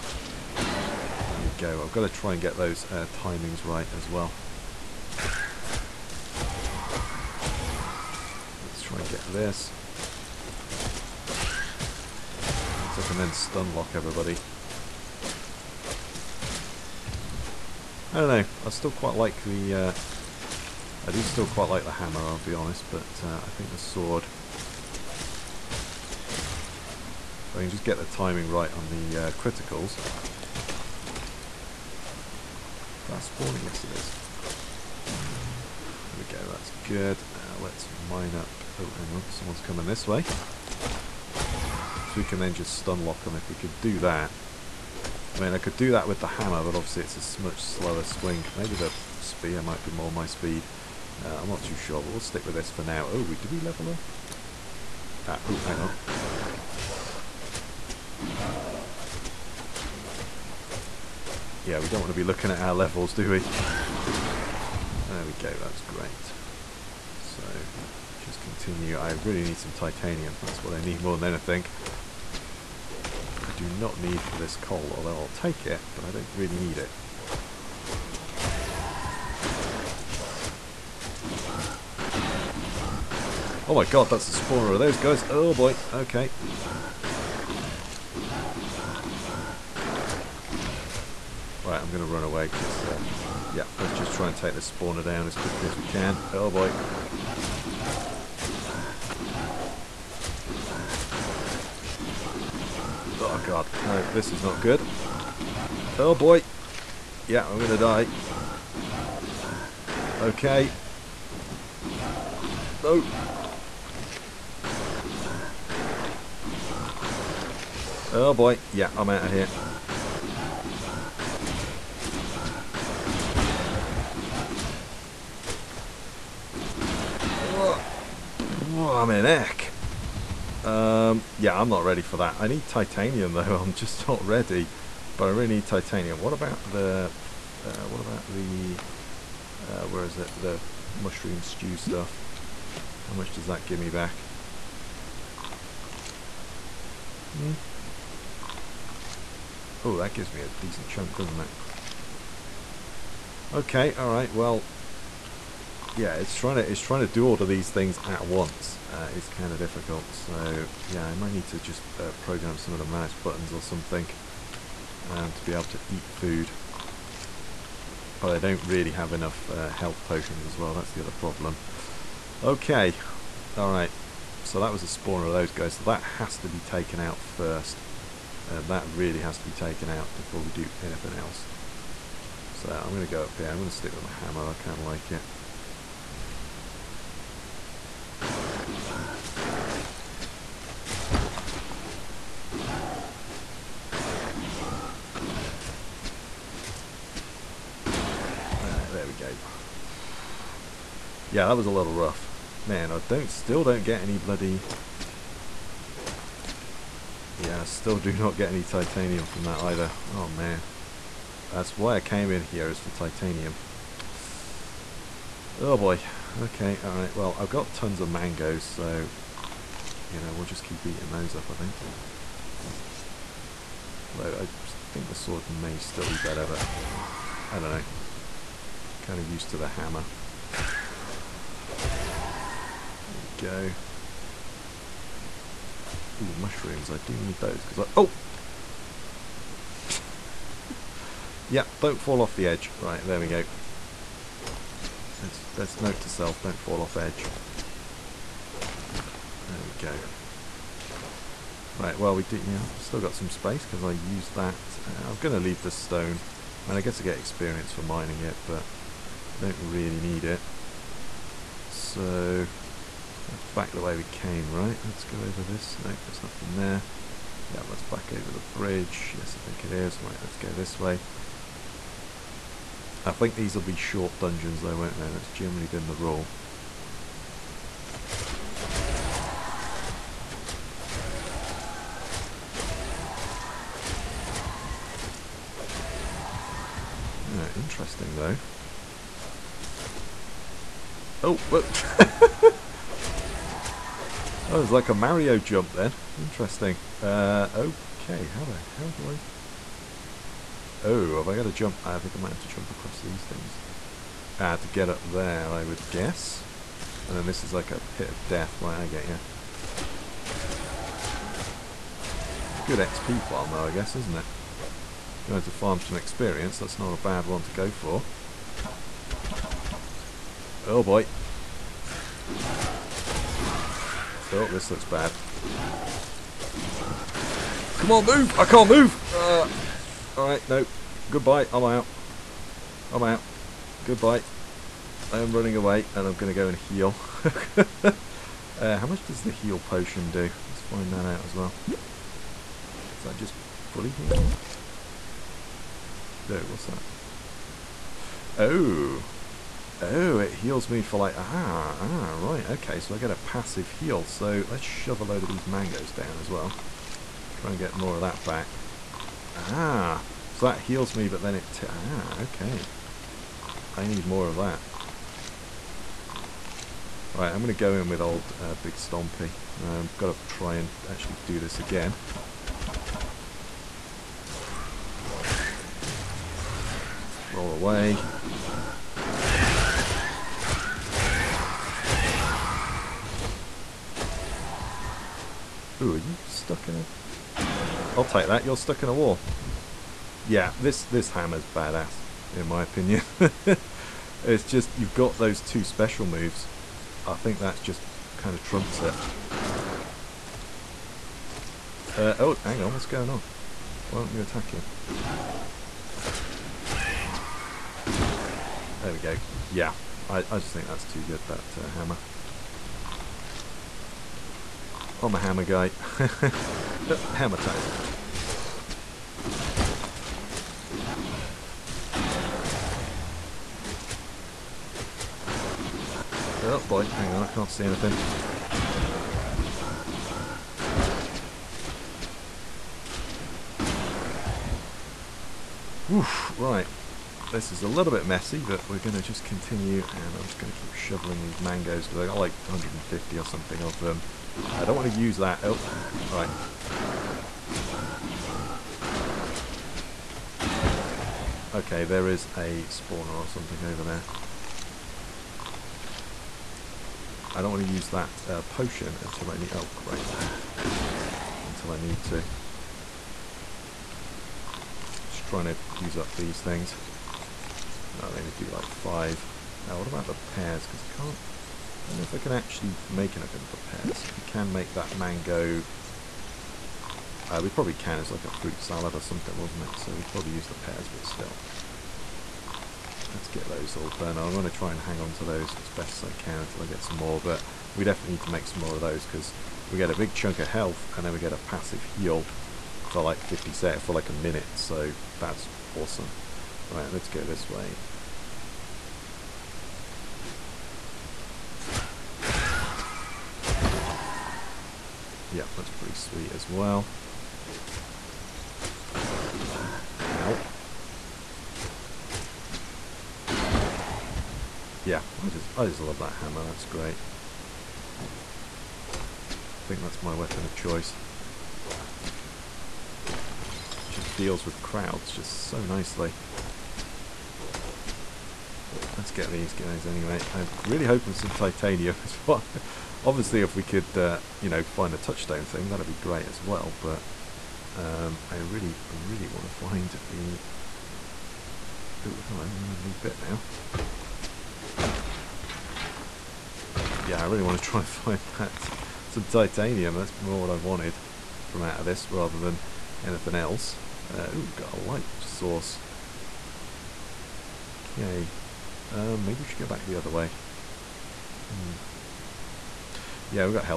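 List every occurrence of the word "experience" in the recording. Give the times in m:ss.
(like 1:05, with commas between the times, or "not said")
4:17, 5:15.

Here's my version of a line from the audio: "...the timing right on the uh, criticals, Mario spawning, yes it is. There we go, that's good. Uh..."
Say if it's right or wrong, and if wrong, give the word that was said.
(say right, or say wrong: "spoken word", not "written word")
wrong: "Fast", not "Mario".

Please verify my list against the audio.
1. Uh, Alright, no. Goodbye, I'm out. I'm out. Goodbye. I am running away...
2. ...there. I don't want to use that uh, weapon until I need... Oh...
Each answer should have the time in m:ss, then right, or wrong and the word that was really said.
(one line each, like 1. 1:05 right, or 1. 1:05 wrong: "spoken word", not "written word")
1. 5:29 right
2. 7:33 wrong: "potion", not "weapon".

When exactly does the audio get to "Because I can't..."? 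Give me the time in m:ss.
7:50.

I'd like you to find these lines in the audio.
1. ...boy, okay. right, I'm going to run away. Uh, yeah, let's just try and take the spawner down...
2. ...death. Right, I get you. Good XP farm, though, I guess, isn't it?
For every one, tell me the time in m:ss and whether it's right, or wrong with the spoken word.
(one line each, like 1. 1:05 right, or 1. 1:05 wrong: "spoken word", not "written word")
1. 1:25 right
2. 5:08 right.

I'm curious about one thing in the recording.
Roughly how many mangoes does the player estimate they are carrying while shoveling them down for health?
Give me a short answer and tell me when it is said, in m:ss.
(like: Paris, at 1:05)
150, at 7:22.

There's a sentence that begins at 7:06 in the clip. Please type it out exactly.
Oh boy, hang on, I can't see anything.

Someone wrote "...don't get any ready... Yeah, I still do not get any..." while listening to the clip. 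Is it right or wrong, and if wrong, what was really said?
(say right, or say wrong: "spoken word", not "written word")
wrong: "bloody", not "ready".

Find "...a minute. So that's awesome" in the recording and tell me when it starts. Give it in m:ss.
8:14.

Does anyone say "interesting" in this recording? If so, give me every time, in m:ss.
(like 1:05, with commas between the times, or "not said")
4:47, 4:56.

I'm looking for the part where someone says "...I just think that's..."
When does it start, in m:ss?
6:50.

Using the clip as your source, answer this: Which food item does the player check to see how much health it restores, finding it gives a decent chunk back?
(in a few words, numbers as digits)
Mushroom stew.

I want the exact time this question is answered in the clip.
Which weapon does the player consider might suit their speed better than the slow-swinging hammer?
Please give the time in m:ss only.
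0:49.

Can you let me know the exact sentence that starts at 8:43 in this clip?
Just deals with crowds just so nicely let's get these guys anyway.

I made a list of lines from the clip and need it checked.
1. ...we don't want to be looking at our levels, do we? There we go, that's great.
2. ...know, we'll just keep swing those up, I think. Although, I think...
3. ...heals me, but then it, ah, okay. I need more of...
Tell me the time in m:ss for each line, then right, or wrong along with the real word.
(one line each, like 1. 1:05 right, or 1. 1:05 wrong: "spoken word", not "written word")
1. 1:01 right
2. 3:40 wrong: "eating", not "swing"
3. 6:00 right.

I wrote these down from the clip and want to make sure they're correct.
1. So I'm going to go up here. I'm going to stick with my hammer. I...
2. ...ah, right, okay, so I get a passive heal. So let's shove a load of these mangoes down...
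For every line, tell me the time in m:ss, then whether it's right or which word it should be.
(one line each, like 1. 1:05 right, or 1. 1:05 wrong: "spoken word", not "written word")
1. 3:02 right
2. 5:51 right.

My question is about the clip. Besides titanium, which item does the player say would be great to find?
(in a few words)
Touchstone.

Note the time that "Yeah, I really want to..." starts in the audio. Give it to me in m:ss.
9:07.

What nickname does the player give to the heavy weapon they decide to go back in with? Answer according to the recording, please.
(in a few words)
Big Stompy.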